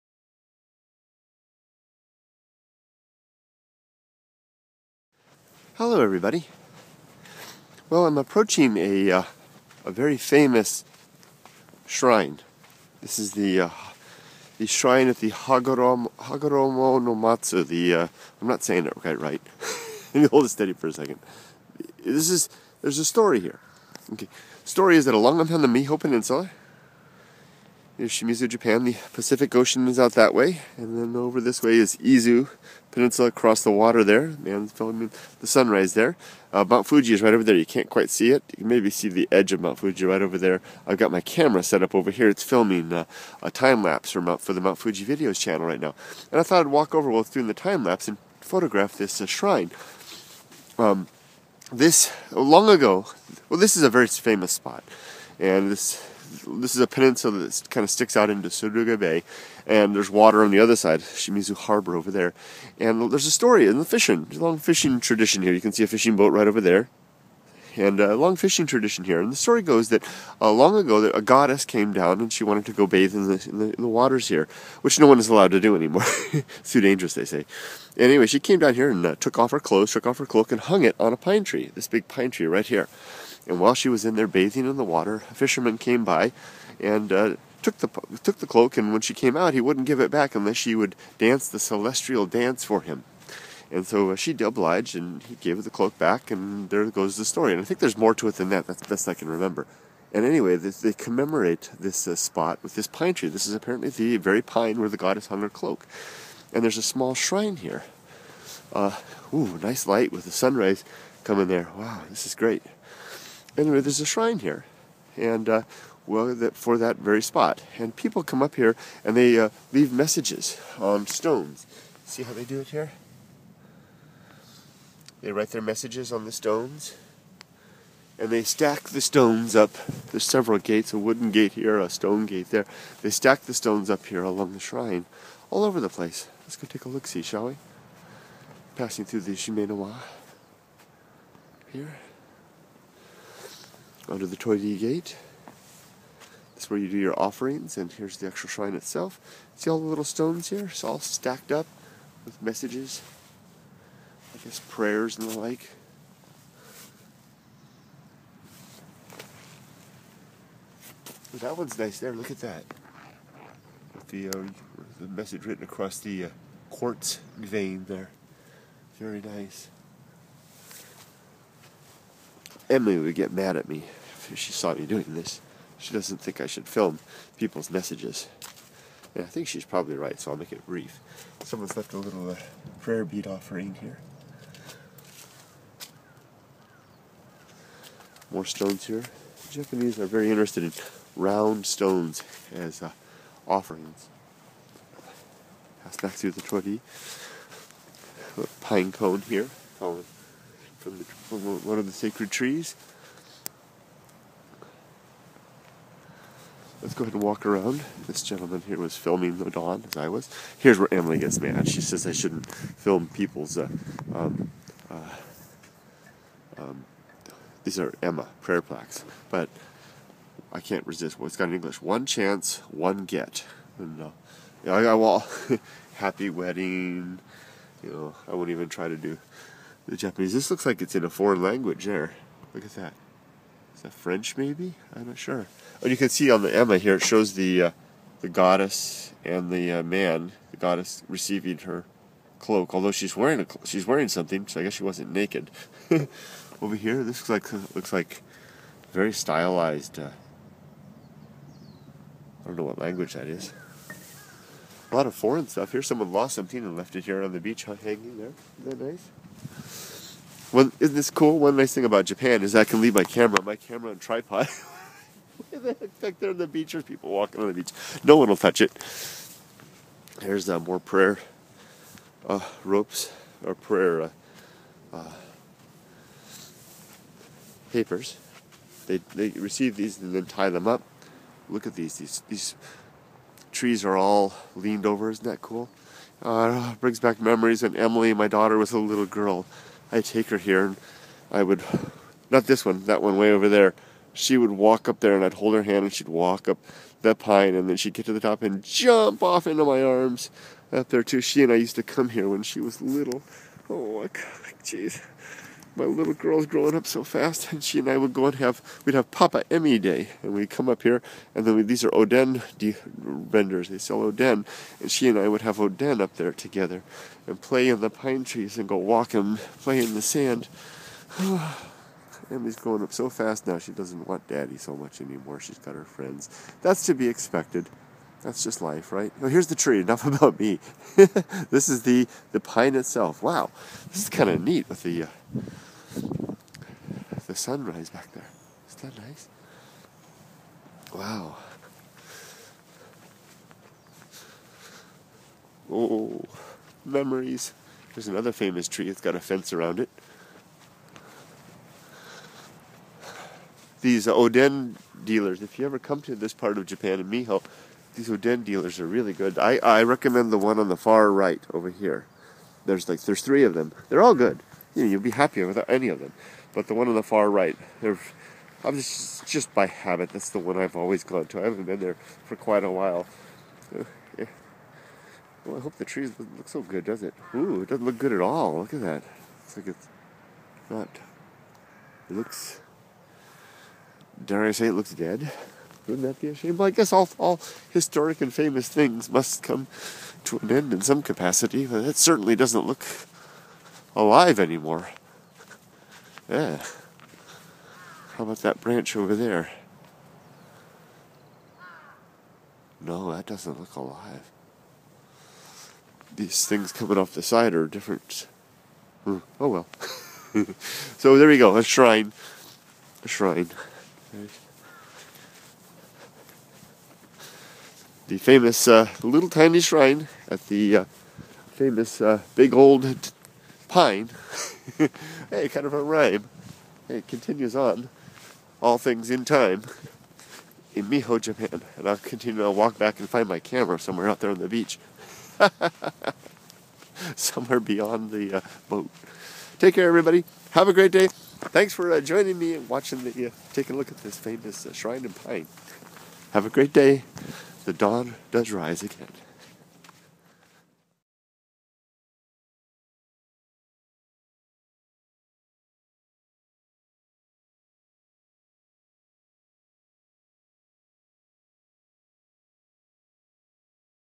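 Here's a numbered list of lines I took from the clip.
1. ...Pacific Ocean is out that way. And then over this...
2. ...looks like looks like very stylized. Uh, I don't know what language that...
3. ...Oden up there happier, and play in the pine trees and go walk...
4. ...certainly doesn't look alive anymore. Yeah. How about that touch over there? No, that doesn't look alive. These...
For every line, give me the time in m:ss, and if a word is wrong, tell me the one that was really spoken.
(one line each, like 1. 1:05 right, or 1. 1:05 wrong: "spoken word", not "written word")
1. 0:29 right
2. 4:07 right
3. 5:15 wrong: "together", not "happier"
4. 6:31 wrong: "branch", not "touch".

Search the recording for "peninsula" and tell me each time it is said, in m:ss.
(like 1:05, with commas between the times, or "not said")
0:25, 0:32, 0:56.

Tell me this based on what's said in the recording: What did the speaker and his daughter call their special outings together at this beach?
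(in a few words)
Papa Emmy Day.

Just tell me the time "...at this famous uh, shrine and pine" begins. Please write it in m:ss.
7:23.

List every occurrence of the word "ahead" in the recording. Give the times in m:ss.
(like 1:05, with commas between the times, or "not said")
3:27.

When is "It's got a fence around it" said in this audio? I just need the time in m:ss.
5:48.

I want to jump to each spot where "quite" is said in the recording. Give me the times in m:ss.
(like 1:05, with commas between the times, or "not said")
0:18, 0:37, 6:12.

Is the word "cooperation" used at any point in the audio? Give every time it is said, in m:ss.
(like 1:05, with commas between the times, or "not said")
not said.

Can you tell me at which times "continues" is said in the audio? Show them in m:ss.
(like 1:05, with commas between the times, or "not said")
7:07, 7:11.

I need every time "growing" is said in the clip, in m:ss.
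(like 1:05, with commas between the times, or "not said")
5:06, 5:22.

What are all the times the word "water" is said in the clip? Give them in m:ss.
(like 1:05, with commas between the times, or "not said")
0:33, 1:00, 1:13, 1:24.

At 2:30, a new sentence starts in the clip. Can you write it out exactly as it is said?
It's all stacked up with messages, I guess prayers and the like.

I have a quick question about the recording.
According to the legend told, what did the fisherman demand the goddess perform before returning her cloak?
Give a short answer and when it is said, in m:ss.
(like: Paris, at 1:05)
the celestial dance, at 1:31.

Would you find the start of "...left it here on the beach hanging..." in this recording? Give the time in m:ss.
4:16.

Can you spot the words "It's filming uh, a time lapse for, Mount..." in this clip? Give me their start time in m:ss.
0:42.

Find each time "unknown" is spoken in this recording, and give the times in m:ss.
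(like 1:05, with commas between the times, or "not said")
not said.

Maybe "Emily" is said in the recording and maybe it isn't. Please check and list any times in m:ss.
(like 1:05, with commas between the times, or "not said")
2:52, 3:30, 4:47.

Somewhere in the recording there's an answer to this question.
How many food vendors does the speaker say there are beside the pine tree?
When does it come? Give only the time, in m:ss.
6:03.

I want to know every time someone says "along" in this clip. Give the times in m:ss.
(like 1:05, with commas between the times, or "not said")
0:25, 2:14.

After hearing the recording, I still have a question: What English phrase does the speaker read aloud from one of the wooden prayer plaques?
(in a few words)
one chance, one get.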